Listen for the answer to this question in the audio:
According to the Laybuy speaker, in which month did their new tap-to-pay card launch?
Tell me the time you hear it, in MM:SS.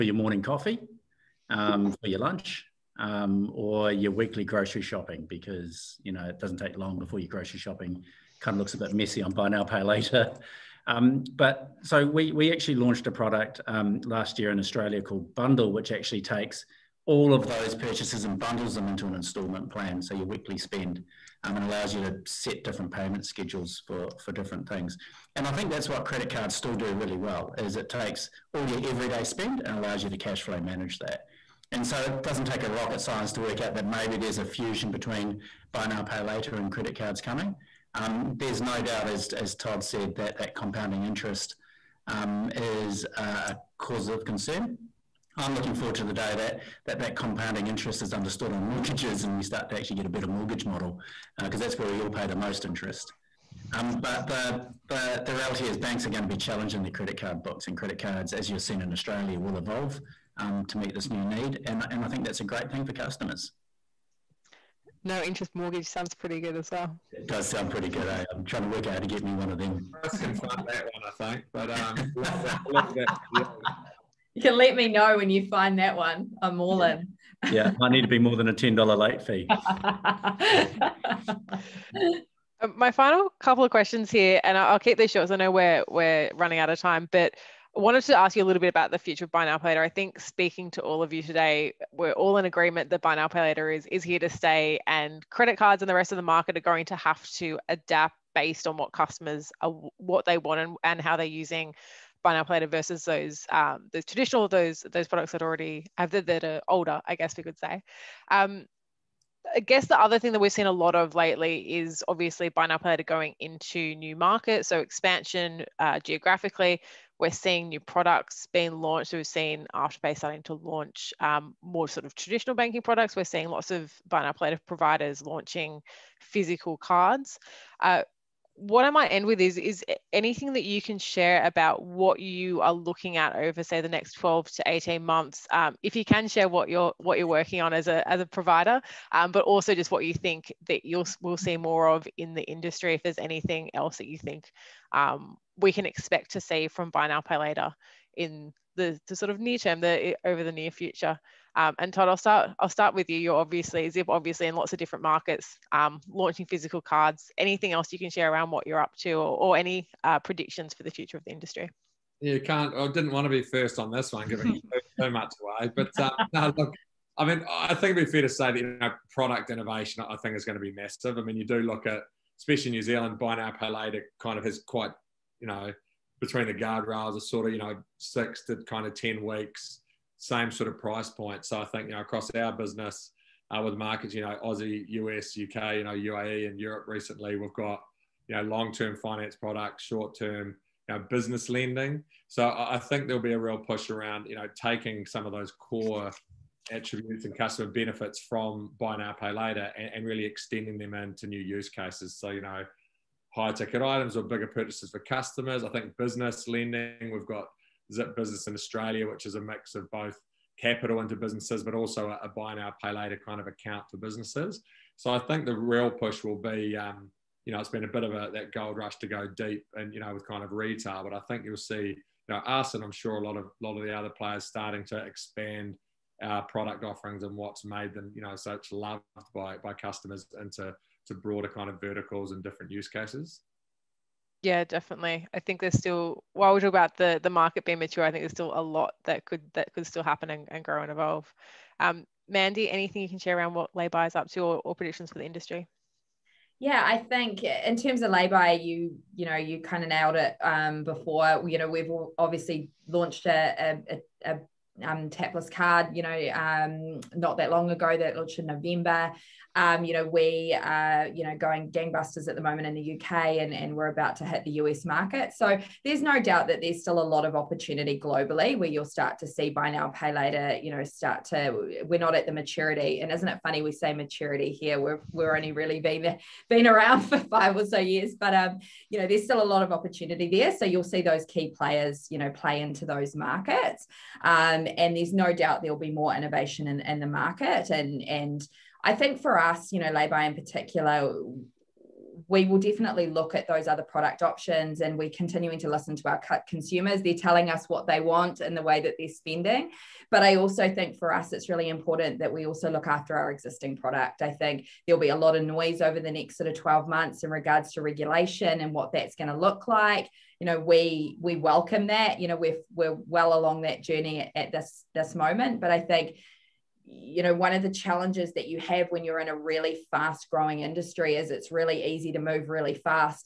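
04:18.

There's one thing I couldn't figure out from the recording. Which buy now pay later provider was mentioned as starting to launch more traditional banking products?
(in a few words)
Afterpay.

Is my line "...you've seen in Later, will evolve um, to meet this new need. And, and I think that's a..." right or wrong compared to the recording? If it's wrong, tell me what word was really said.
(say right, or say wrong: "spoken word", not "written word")
wrong: "Australia", not "Later".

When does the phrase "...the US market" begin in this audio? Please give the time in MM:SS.
04:24.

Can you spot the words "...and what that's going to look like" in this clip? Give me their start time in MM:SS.
05:08.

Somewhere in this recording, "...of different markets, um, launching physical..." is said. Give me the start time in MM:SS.
02:34.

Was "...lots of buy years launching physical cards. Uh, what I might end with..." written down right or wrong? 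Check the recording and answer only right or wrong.
wrong.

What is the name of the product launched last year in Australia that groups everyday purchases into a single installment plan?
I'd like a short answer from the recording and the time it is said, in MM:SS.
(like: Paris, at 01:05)
Bundle, at 00:15.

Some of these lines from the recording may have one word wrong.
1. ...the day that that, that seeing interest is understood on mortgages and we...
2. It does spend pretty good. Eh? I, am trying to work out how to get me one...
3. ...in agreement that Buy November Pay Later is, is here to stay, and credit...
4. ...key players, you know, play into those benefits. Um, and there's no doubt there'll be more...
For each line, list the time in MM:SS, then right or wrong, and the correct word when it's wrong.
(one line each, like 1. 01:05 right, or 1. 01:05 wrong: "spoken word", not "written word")
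1. 00:46 wrong: "compounding", not "seeing"
2. 01:07 wrong: "sound", not "spend"
3. 01:32 wrong: "Now", not "November"
4. 04:41 wrong: "markets", not "benefits".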